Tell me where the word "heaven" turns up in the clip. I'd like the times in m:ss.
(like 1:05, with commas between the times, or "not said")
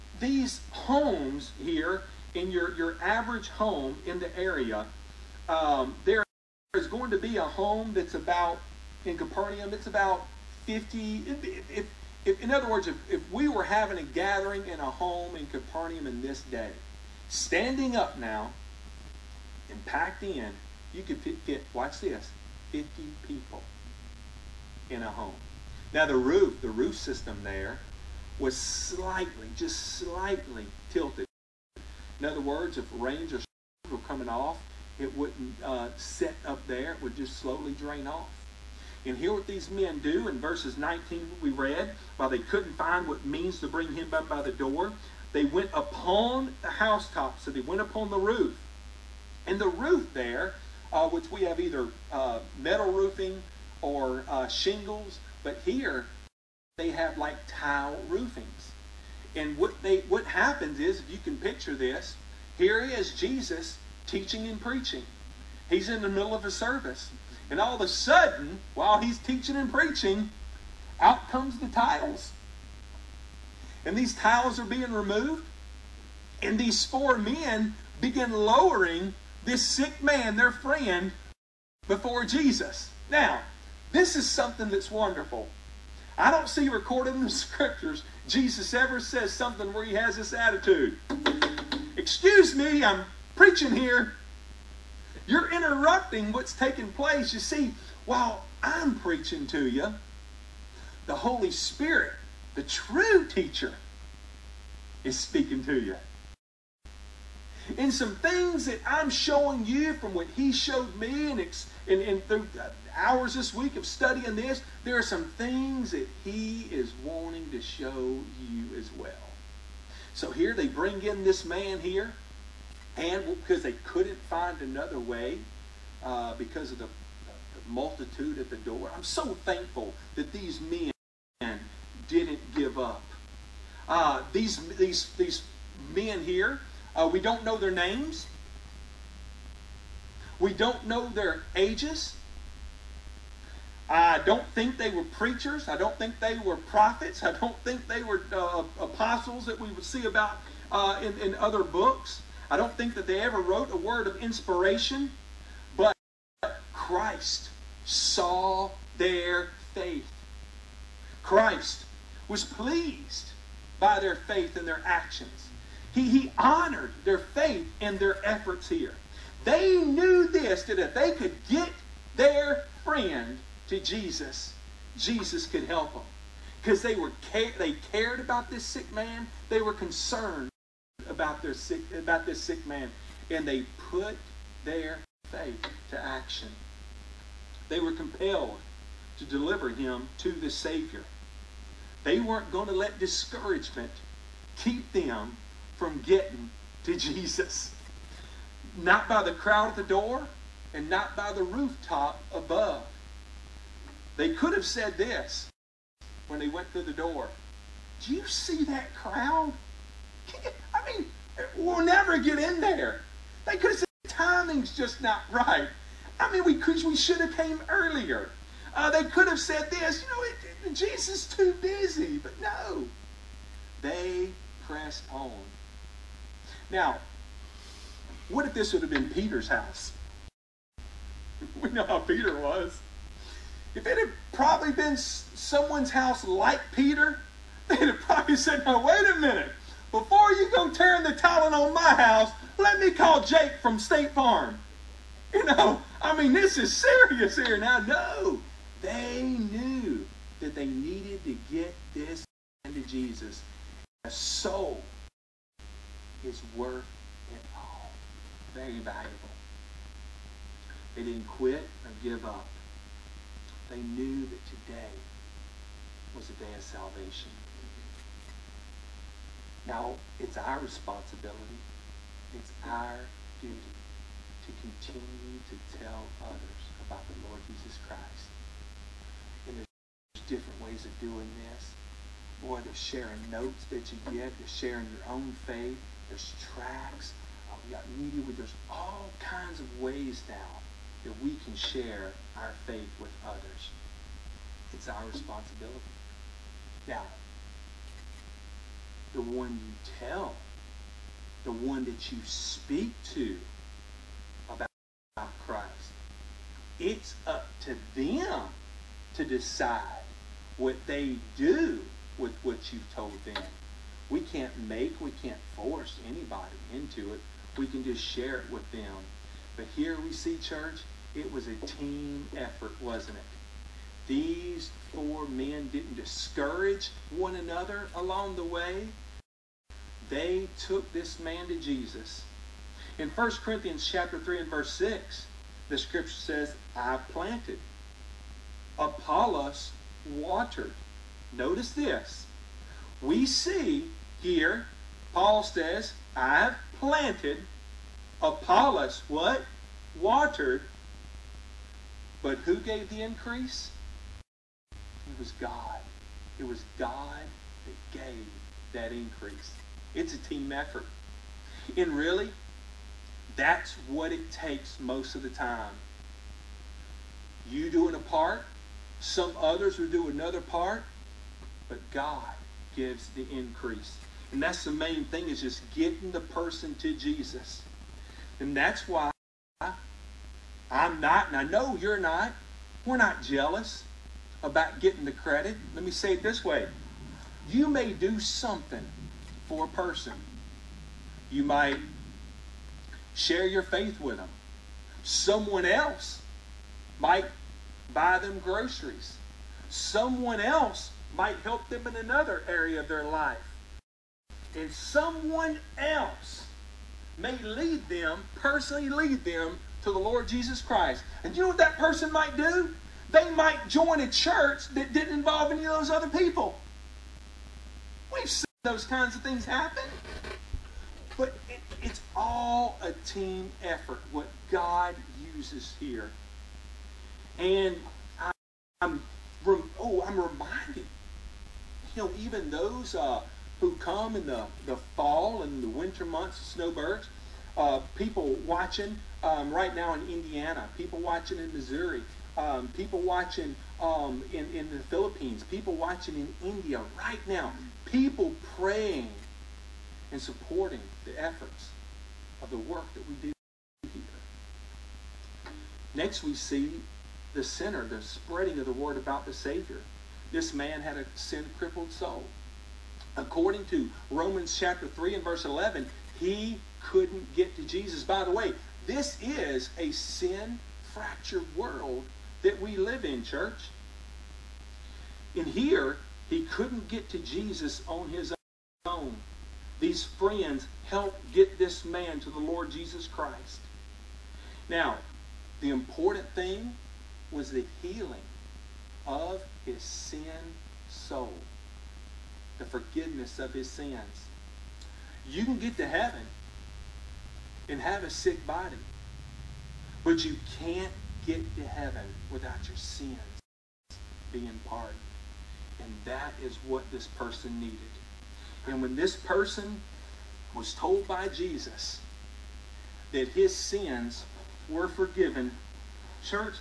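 8:15, 8:21.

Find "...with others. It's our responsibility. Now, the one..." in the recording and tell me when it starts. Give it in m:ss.
4:53.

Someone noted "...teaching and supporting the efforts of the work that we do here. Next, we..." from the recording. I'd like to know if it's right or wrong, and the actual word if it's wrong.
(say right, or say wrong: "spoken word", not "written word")
wrong: "praying", not "teaching".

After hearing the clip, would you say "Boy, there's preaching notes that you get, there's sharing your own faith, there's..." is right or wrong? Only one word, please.
wrong.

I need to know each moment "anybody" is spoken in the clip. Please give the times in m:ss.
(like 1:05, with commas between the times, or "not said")
5:16.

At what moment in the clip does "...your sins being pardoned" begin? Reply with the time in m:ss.
8:22.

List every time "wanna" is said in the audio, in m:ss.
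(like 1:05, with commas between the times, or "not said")
not said.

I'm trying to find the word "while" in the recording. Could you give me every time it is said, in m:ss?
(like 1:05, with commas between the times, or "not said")
0:42, 1:08, 1:38.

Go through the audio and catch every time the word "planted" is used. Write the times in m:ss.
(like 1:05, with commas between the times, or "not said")
5:37, 5:46.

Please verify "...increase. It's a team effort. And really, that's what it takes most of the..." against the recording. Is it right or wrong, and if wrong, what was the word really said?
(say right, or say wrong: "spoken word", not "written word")
right.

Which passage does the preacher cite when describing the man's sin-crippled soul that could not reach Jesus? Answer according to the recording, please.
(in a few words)
Romans 3:11.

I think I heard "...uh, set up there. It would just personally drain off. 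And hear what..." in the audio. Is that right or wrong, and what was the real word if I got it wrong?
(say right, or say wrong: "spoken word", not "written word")
wrong: "slowly", not "personally".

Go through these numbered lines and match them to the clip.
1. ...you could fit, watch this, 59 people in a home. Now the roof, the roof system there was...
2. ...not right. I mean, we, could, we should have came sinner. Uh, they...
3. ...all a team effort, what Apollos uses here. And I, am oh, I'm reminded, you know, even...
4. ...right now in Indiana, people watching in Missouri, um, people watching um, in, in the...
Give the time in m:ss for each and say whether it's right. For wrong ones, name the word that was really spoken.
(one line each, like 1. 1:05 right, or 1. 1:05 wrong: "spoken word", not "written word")
1. 0:20 wrong: "50", not "59"
2. 3:35 wrong: "earlier", not "sinner"
3. 7:02 wrong: "God", not "Apollos"
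4. 7:19 right.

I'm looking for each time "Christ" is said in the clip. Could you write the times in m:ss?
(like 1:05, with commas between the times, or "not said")
2:36, 2:41, 4:37, 5:05, 6:50, 8:03.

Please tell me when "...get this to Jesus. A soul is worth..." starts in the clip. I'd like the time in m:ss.
4:11.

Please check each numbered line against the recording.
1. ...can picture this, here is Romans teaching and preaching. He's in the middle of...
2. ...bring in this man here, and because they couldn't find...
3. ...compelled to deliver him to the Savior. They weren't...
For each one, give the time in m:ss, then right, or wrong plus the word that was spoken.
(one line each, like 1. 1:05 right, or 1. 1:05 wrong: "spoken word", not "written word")
1. 1:01 wrong: "Jesus", not "Romans"
2. 2:00 right
3. 3:07 right.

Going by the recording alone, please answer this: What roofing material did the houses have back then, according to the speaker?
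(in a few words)
tile roofings.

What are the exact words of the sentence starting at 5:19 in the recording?
But here we see, church, it was a team effort, wasn't it?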